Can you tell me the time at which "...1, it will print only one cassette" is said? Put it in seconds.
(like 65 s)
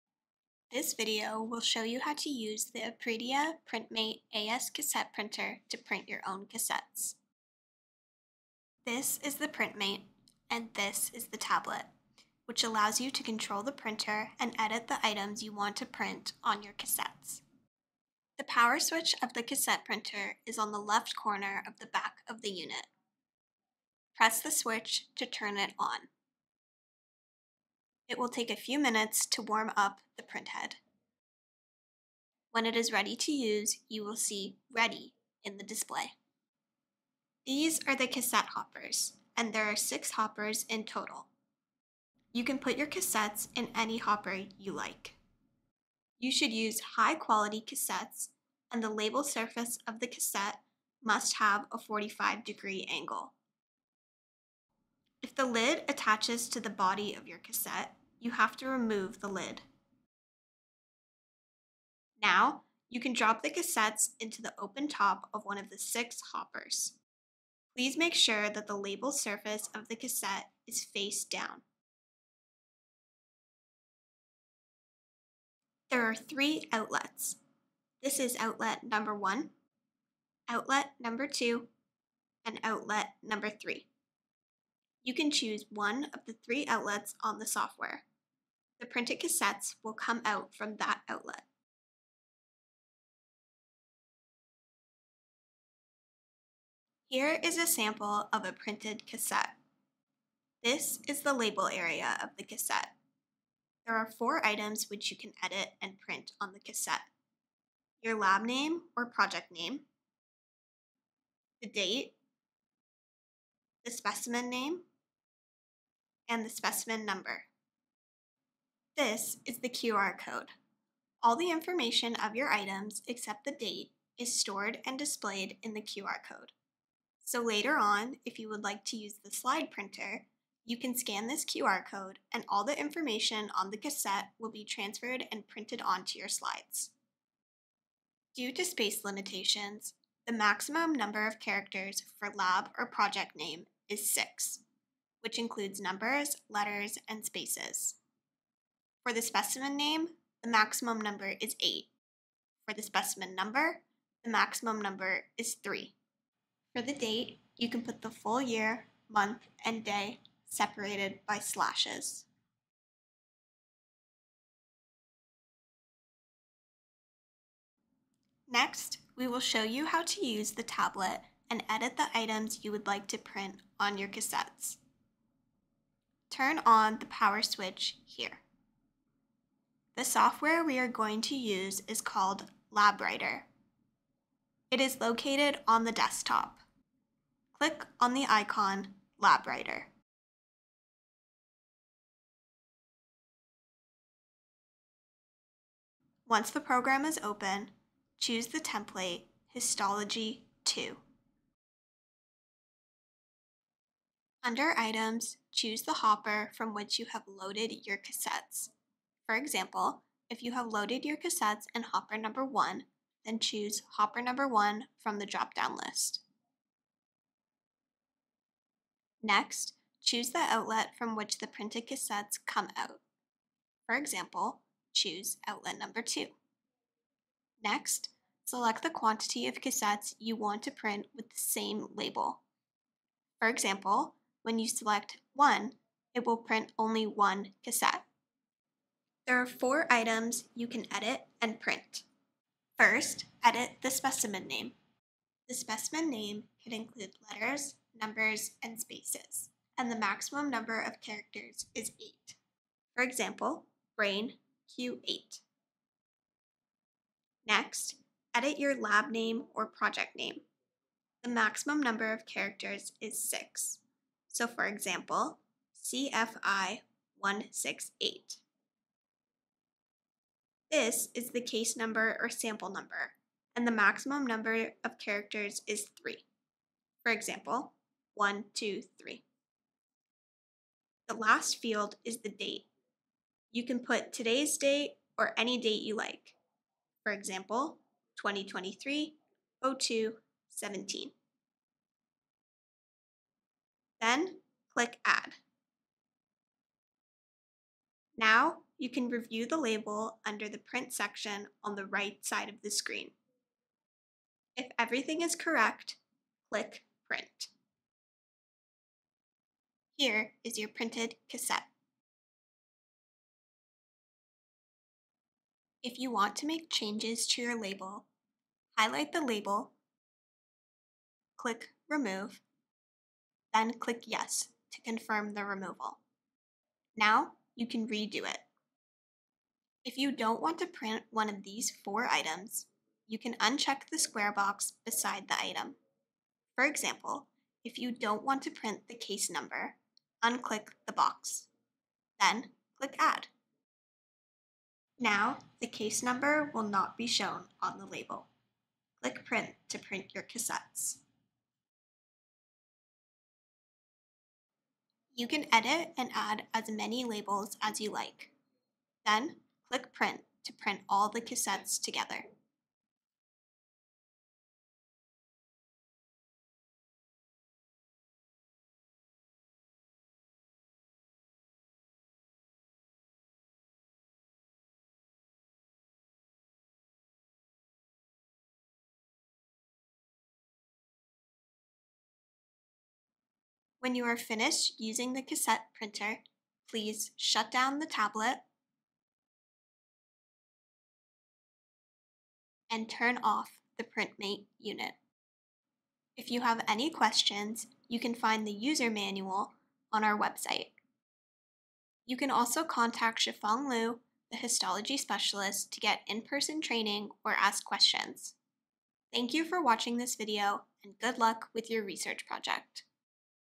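235 s.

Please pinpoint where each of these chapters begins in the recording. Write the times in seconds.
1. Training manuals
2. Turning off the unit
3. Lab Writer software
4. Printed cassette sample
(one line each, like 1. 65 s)
1. 398 s
2. 386 s
3. 195 s
4. 95 s.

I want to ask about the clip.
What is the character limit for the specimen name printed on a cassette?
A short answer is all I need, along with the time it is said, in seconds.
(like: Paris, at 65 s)
8, at 149 s.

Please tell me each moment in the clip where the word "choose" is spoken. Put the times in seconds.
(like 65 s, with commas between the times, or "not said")
85 s, 198 s, 205 s, 213 s, 220 s, 224 s.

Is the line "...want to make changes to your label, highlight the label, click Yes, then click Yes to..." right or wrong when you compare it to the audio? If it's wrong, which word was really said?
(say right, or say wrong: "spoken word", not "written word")
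wrong: "Remove", not "Yes".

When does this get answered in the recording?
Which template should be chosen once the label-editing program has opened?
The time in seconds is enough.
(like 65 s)
199 s.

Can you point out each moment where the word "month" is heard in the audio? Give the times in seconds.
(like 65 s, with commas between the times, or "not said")
159 s.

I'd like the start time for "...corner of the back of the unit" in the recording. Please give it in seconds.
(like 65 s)
21 s.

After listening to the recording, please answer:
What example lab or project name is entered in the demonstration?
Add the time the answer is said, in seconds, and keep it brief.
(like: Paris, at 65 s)
CFI 168, at 265 s.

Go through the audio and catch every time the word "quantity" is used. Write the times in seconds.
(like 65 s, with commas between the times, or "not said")
228 s.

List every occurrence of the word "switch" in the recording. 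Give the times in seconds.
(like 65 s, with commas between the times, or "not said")
18 s, 24 s, 177 s.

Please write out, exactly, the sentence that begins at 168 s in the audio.
Next, we will show you how to use the tablet and edit the items you would like to print on your cassettes.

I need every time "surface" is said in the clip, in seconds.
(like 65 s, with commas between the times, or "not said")
49 s, 69 s.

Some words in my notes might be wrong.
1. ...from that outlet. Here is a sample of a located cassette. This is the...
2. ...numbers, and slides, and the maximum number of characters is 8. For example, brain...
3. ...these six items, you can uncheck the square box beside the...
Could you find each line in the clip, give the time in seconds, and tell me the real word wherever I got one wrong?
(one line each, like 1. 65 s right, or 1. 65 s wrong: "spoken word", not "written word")
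1. 90 s wrong: "printed", not "located"
2. 247 s wrong: "spaces", not "slides"
3. 331 s wrong: "four", not "six".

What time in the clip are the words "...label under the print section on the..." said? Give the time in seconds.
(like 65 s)
299 s.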